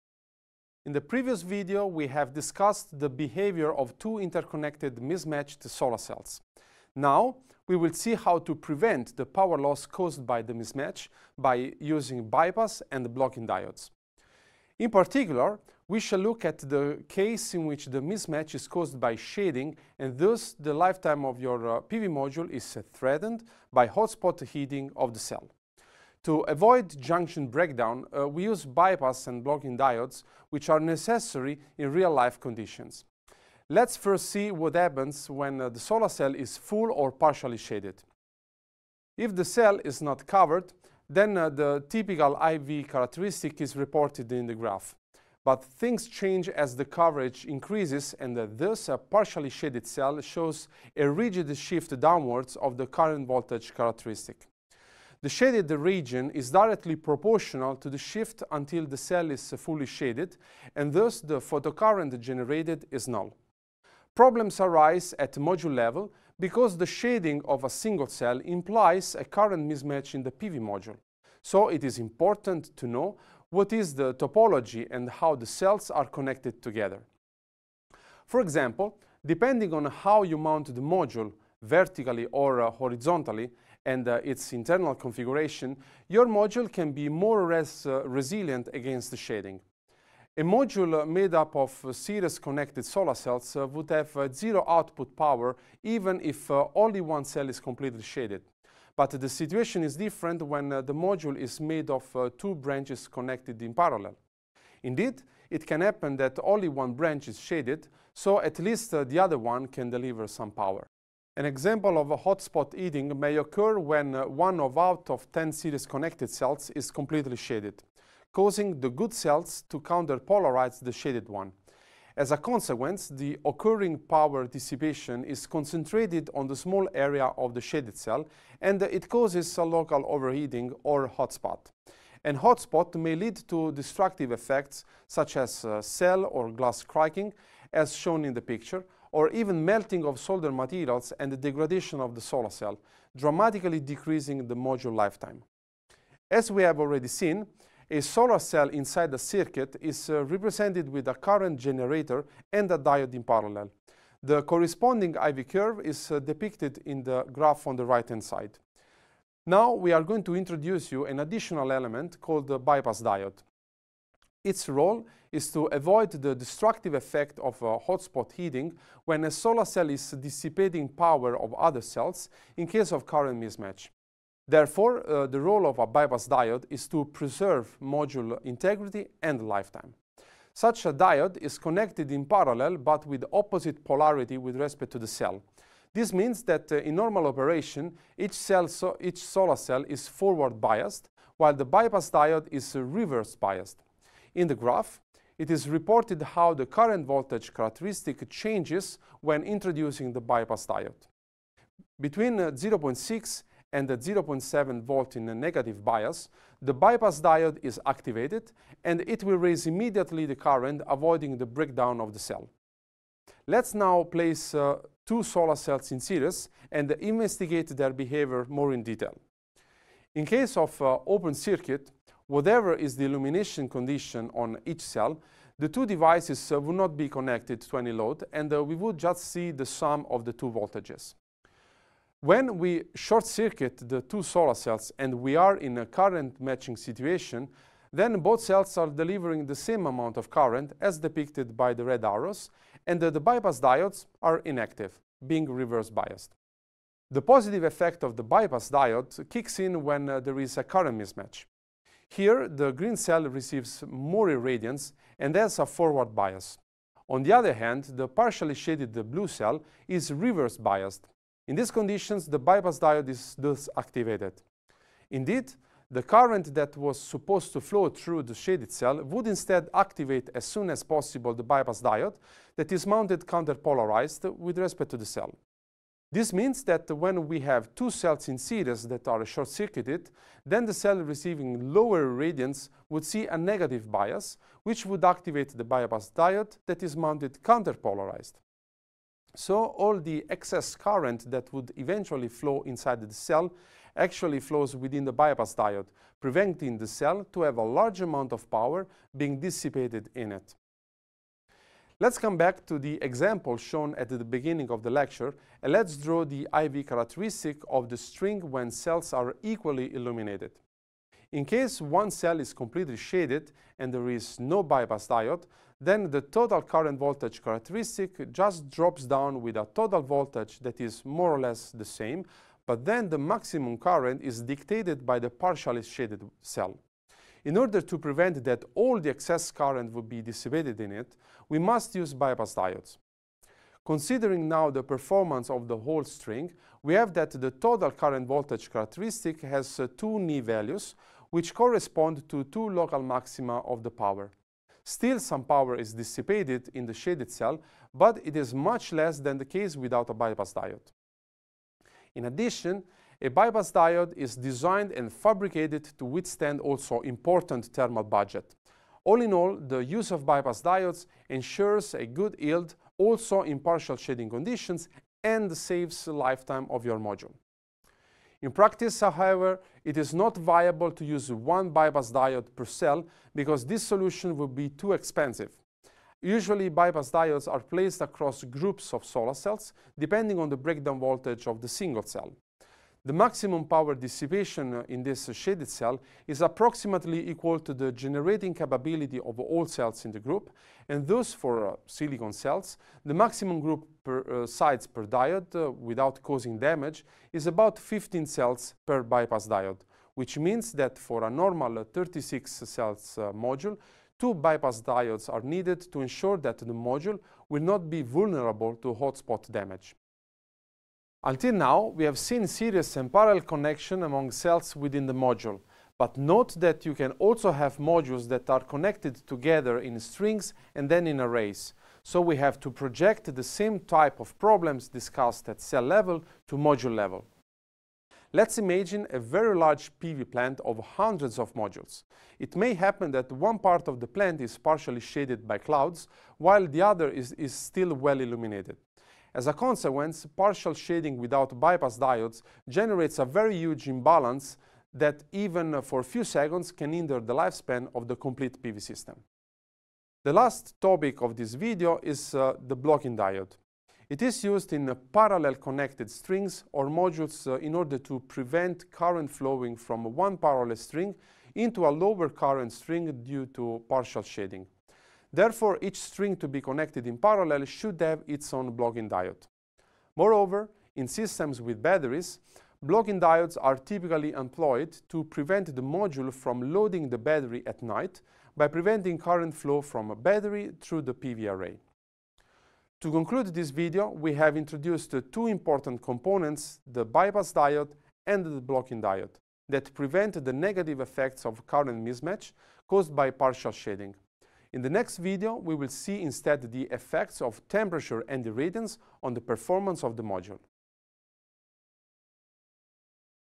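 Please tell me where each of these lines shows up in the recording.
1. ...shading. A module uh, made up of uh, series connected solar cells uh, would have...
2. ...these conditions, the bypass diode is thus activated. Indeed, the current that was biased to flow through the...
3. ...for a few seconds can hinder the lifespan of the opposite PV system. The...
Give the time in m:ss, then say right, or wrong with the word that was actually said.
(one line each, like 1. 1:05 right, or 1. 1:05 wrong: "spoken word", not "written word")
1. 1:29 right
2. 4:21 wrong: "supposed", not "biased"
3. 7:25 wrong: "complete", not "opposite".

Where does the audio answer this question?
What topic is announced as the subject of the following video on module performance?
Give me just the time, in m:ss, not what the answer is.
8:17.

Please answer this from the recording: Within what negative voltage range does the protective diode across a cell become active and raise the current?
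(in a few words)
0.6 to 0.7 volt.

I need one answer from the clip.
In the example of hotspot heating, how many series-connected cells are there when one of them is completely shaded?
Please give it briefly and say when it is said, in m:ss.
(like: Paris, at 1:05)
10, at 1:55.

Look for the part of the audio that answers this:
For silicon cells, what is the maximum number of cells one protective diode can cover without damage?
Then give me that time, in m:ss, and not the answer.
6:37.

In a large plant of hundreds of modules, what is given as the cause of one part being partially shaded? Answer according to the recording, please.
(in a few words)
Clouds.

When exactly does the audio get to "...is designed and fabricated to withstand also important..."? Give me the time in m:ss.
5:54.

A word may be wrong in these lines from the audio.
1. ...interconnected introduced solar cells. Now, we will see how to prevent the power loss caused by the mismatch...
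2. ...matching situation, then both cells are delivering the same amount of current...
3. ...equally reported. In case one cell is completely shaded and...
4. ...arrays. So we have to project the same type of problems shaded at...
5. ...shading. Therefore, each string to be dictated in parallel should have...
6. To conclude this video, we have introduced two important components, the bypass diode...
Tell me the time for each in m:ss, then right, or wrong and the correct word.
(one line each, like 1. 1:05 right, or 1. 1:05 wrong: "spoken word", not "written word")
1. 0:04 wrong: "mismatched", not "introduced"
2. 3:56 right
3. 5:09 wrong: "illuminated", not "reported"
4. 7:01 wrong: "discussed", not "shaded"
5. 7:44 wrong: "connected", not "dictated"
6. 8:02 right.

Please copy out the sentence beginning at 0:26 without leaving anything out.
To avoid junction breakdown, uh, we use bypass and blocking diodes, which are necessary in real-life conditions.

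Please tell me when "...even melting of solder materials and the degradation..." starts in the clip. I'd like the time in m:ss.
2:19.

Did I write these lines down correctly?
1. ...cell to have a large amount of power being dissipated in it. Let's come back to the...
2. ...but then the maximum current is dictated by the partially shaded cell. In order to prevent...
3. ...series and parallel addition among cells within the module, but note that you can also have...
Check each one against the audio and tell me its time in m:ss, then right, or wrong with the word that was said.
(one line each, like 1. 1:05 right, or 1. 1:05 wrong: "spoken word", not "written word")
1. 4:56 right
2. 5:22 right
3. 6:52 wrong: "connection", not "addition".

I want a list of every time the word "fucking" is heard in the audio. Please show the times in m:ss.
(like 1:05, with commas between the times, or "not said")
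not said.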